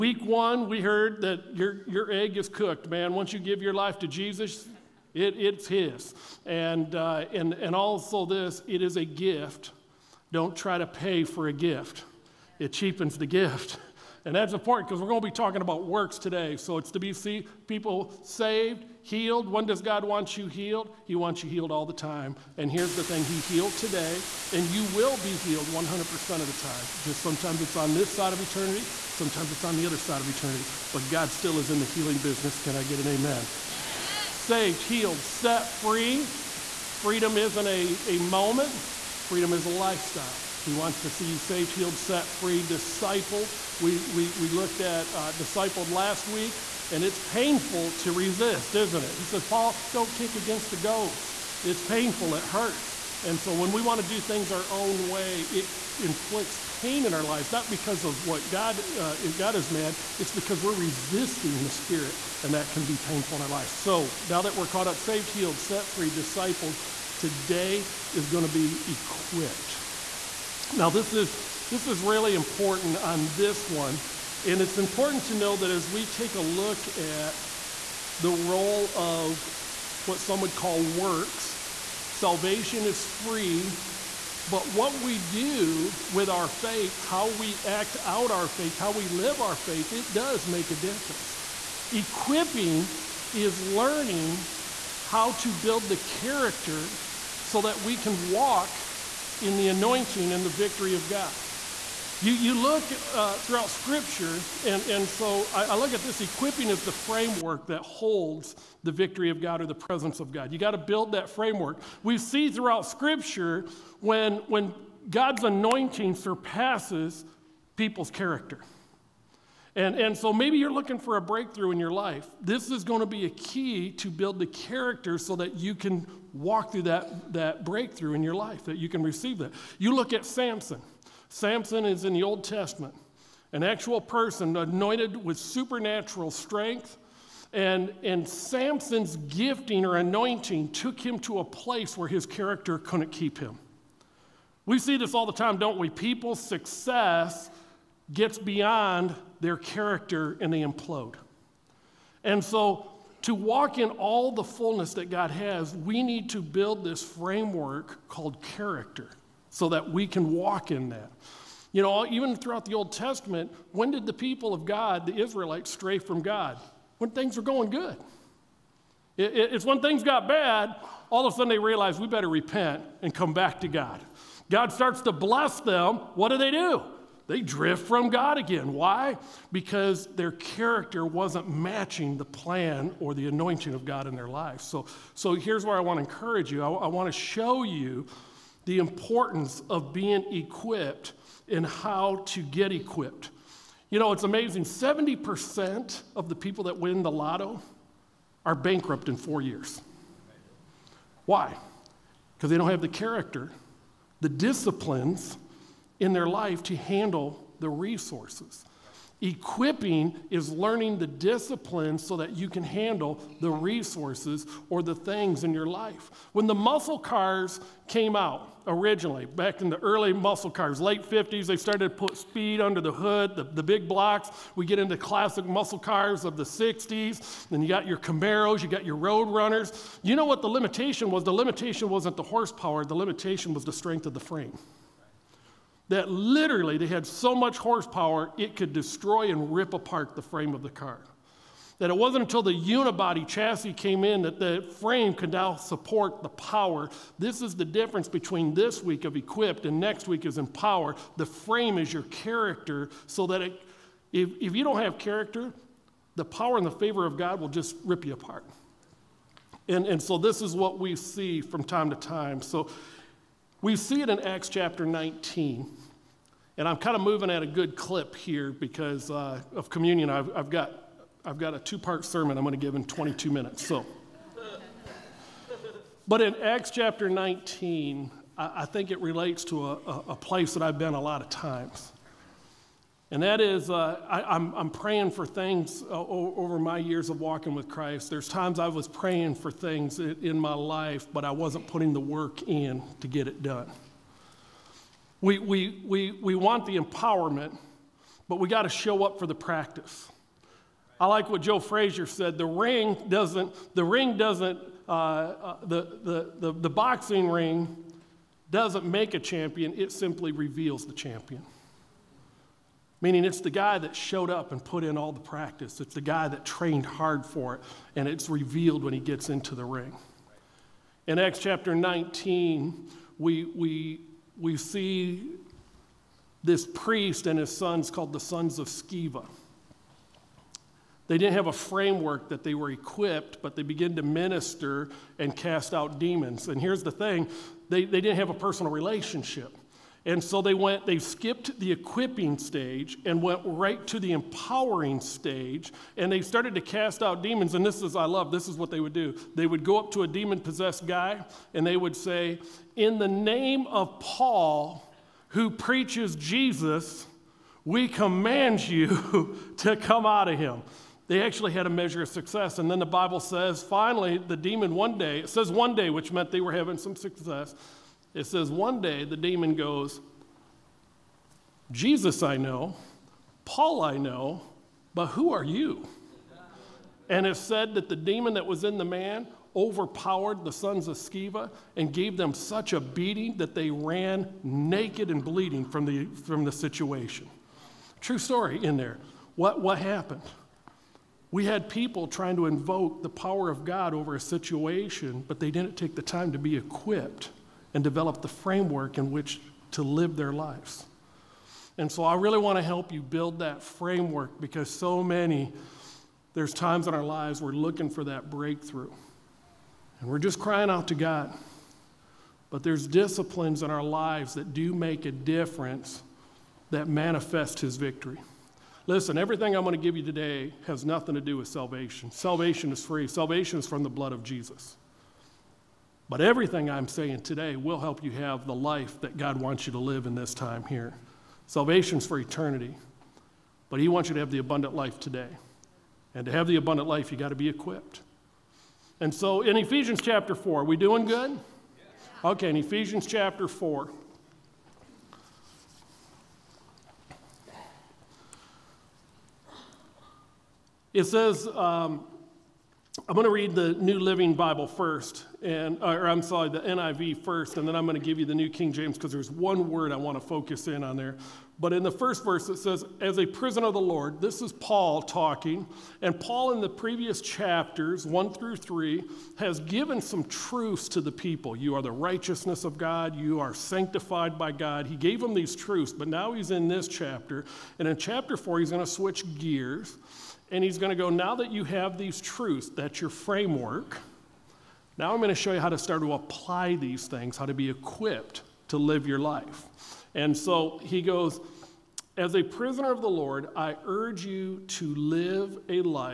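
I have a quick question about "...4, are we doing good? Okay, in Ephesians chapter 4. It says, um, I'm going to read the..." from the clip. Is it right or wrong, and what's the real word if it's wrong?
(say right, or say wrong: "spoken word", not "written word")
right.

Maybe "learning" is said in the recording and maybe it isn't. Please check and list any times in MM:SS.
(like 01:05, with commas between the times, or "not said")
01:33, 03:30.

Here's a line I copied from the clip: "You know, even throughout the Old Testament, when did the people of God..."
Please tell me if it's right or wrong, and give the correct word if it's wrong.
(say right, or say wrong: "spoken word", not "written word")
right.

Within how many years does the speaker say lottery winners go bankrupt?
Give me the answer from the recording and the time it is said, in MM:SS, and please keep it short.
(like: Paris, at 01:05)
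4, at 03:19.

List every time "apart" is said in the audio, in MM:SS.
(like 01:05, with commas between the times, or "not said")
03:59, 04:18.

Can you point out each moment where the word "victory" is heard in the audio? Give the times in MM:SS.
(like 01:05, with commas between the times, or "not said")
01:40, 01:48, 06:57.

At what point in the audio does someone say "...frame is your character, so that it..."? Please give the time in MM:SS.
04:11.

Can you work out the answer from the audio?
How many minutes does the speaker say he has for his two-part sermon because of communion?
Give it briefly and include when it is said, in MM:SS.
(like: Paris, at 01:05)
22, at 04:32.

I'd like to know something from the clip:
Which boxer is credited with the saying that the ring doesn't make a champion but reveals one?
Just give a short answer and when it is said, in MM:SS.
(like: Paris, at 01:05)
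Joe Frazier, at 05:01.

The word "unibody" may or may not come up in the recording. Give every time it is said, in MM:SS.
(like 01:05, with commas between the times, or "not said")
04:02.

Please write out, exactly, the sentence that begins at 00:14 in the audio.
And that's important because we're going to be talking about works today.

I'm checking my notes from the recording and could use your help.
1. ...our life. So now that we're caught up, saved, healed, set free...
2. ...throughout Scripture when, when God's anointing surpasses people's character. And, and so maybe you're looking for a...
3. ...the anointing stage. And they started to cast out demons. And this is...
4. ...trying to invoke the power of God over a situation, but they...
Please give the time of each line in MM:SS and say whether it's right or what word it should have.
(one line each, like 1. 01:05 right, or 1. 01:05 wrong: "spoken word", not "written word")
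1. 01:03 right
2. 01:52 right
3. 05:44 wrong: "empowering", not "anointing"
4. 06:32 right.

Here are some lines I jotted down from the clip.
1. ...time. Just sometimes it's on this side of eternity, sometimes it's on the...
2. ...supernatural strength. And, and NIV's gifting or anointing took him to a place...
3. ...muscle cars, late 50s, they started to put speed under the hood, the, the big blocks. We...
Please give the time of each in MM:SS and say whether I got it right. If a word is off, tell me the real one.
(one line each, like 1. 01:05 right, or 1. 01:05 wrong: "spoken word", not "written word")
1. 00:26 right
2. 02:15 wrong: "Samson", not "NIV"
3. 03:40 right.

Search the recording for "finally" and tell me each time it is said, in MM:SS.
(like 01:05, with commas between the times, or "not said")
06:03.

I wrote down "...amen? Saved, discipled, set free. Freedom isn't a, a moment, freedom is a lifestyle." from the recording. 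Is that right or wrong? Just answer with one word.
wrong.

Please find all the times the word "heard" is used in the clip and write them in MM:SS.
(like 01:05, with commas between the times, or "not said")
00:00.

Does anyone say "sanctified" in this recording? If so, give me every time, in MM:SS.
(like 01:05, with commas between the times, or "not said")
07:53.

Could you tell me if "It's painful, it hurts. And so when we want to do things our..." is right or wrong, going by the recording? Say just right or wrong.
right.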